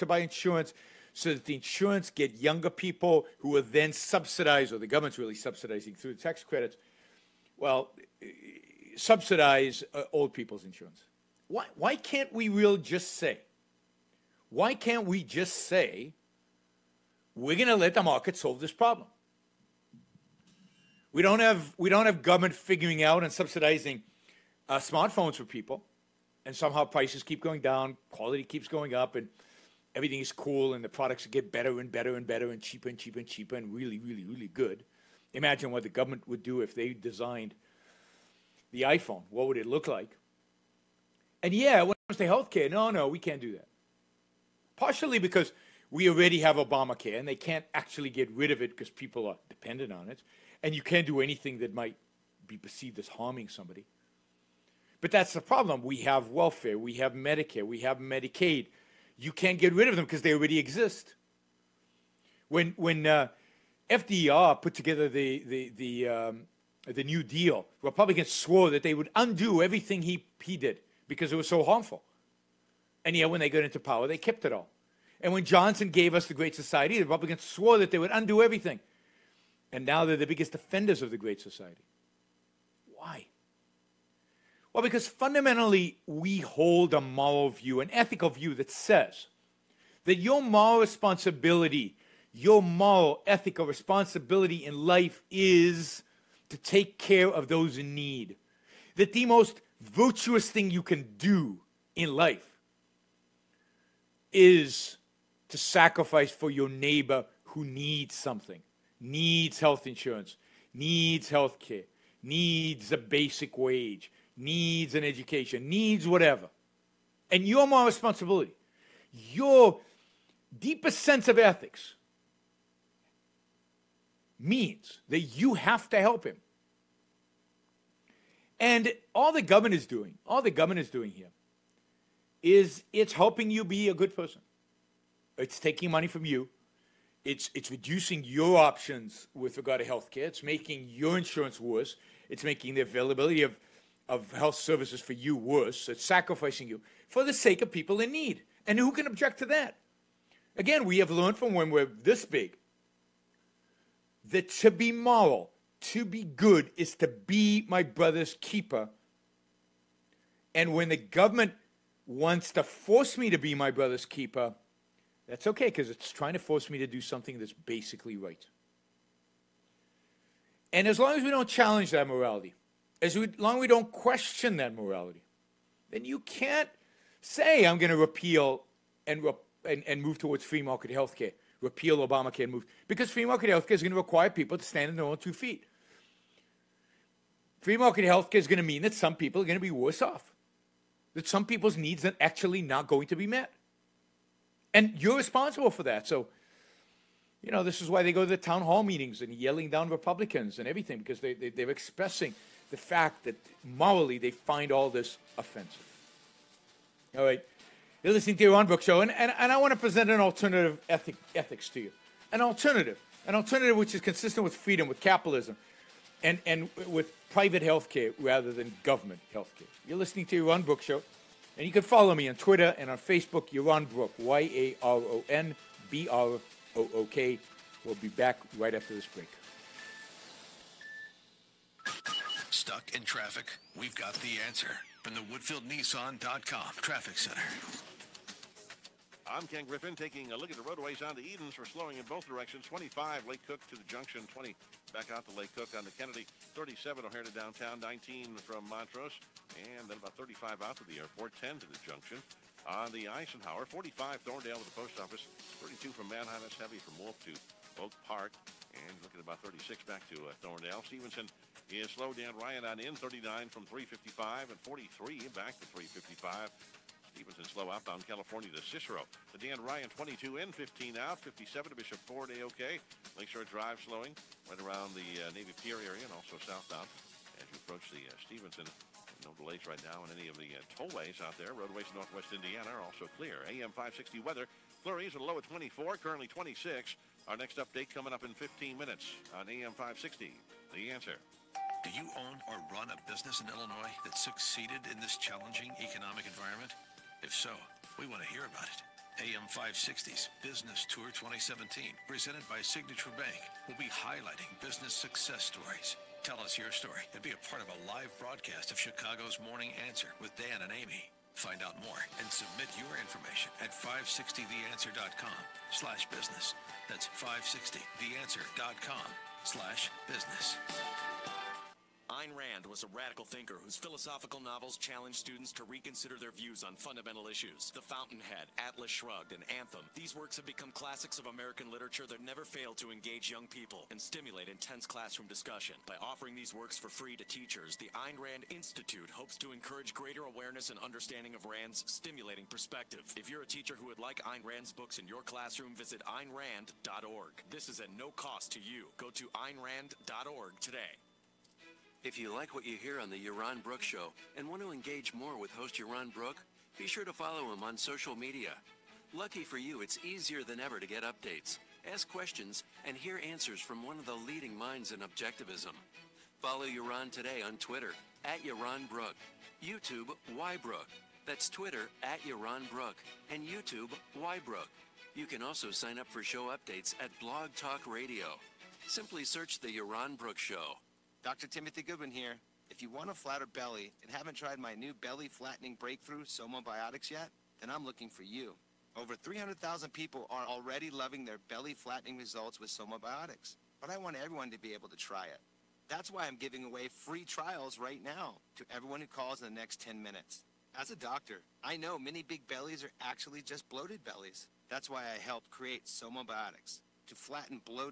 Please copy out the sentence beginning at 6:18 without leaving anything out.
Simply search The Yaron Brook Show.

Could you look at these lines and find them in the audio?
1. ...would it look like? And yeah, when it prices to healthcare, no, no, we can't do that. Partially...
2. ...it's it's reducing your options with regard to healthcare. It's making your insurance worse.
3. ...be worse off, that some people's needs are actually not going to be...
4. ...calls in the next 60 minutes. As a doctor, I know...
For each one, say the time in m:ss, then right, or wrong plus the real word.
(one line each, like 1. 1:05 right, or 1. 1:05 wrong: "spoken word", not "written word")
1. 0:39 wrong: "comes", not "prices"
2. 2:17 right
3. 3:09 right
4. 6:39 wrong: "10", not "60".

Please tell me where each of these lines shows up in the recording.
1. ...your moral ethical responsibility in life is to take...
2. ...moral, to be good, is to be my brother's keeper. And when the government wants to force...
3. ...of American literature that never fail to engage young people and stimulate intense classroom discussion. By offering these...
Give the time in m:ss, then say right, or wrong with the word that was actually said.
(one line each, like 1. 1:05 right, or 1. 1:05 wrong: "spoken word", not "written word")
1. 1:32 right
2. 2:34 right
3. 5:31 right.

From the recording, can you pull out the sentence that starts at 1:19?
And now they're the biggest defenders of the Great Society.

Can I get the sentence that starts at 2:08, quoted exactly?
And all the government is doing, all the government is doing here is it's helping you be a good person.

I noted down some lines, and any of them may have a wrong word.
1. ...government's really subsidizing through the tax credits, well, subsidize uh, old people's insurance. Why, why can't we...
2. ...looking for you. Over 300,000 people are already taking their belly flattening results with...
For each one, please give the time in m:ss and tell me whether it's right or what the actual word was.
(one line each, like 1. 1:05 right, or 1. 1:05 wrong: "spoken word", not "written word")
1. 0:04 right
2. 6:27 wrong: "loving", not "taking".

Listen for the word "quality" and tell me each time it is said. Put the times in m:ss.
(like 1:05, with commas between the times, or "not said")
0:28.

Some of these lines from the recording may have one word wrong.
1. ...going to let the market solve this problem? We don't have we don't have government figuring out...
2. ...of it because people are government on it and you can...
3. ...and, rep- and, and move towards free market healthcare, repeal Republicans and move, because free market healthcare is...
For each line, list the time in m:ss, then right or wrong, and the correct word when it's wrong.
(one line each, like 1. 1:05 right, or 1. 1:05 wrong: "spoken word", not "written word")
1. 0:17 right
2. 0:48 wrong: "dependent", not "government"
3. 2:59 wrong: "Obamacare", not "Republicans".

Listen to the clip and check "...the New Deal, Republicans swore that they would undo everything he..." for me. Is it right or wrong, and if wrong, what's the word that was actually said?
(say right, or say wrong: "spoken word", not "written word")
right.